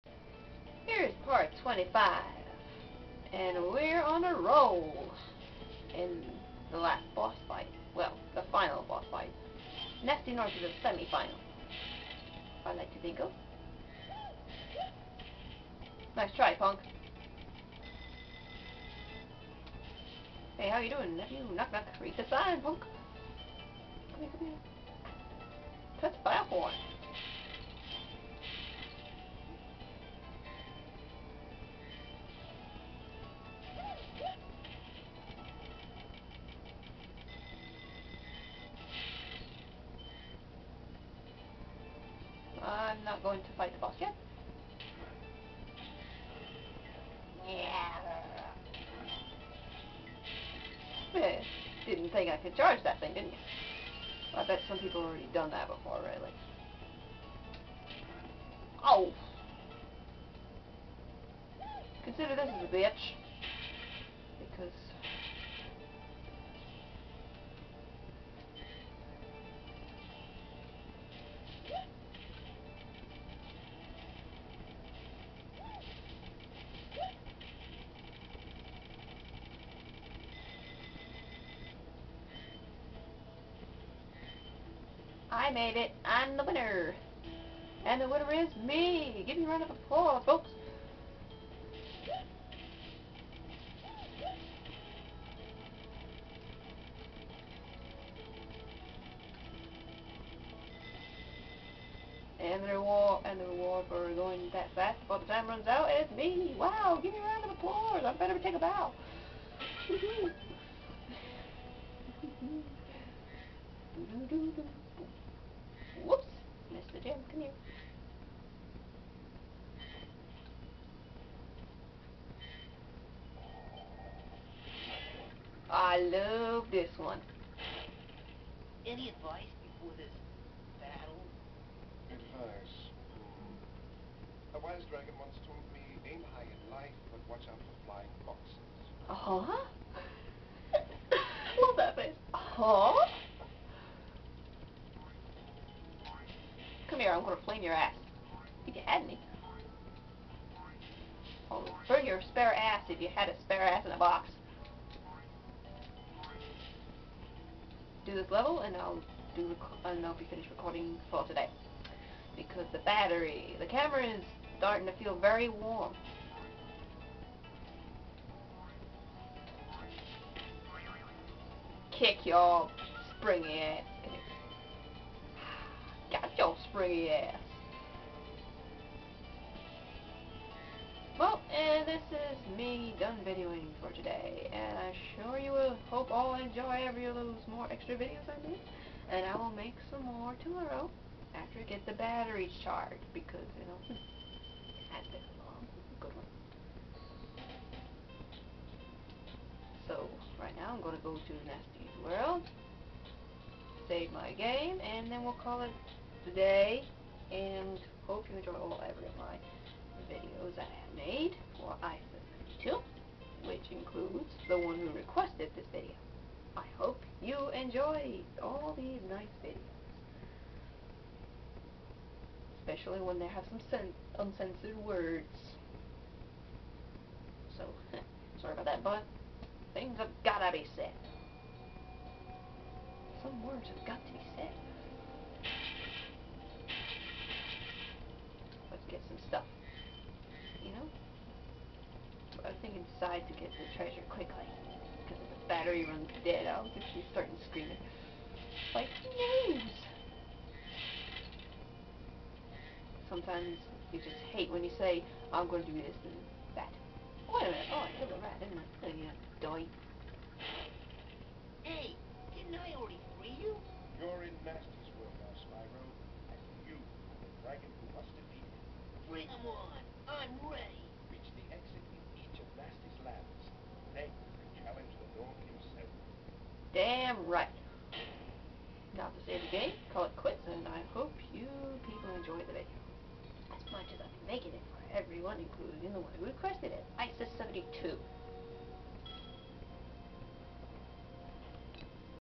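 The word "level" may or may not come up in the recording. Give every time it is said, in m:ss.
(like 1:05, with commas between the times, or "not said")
2:38.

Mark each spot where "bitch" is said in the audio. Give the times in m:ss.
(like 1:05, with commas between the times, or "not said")
1:02.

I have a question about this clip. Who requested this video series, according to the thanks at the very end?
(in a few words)
Isa 72.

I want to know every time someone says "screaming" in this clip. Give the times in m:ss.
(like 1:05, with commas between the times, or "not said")
4:07.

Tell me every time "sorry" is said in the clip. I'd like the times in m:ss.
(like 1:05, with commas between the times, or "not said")
3:48.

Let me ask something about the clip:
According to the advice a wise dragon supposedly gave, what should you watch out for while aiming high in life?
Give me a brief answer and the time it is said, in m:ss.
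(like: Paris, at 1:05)
flying foxes, at 2:17.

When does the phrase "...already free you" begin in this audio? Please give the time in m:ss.
4:22.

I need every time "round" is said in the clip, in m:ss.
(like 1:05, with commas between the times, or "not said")
1:29, 1:47.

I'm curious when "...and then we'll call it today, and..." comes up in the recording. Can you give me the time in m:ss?
3:24.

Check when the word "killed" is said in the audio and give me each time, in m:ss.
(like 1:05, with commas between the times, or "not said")
4:17.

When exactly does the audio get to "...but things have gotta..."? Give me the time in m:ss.
3:48.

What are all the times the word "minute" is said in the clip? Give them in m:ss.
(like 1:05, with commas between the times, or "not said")
4:17.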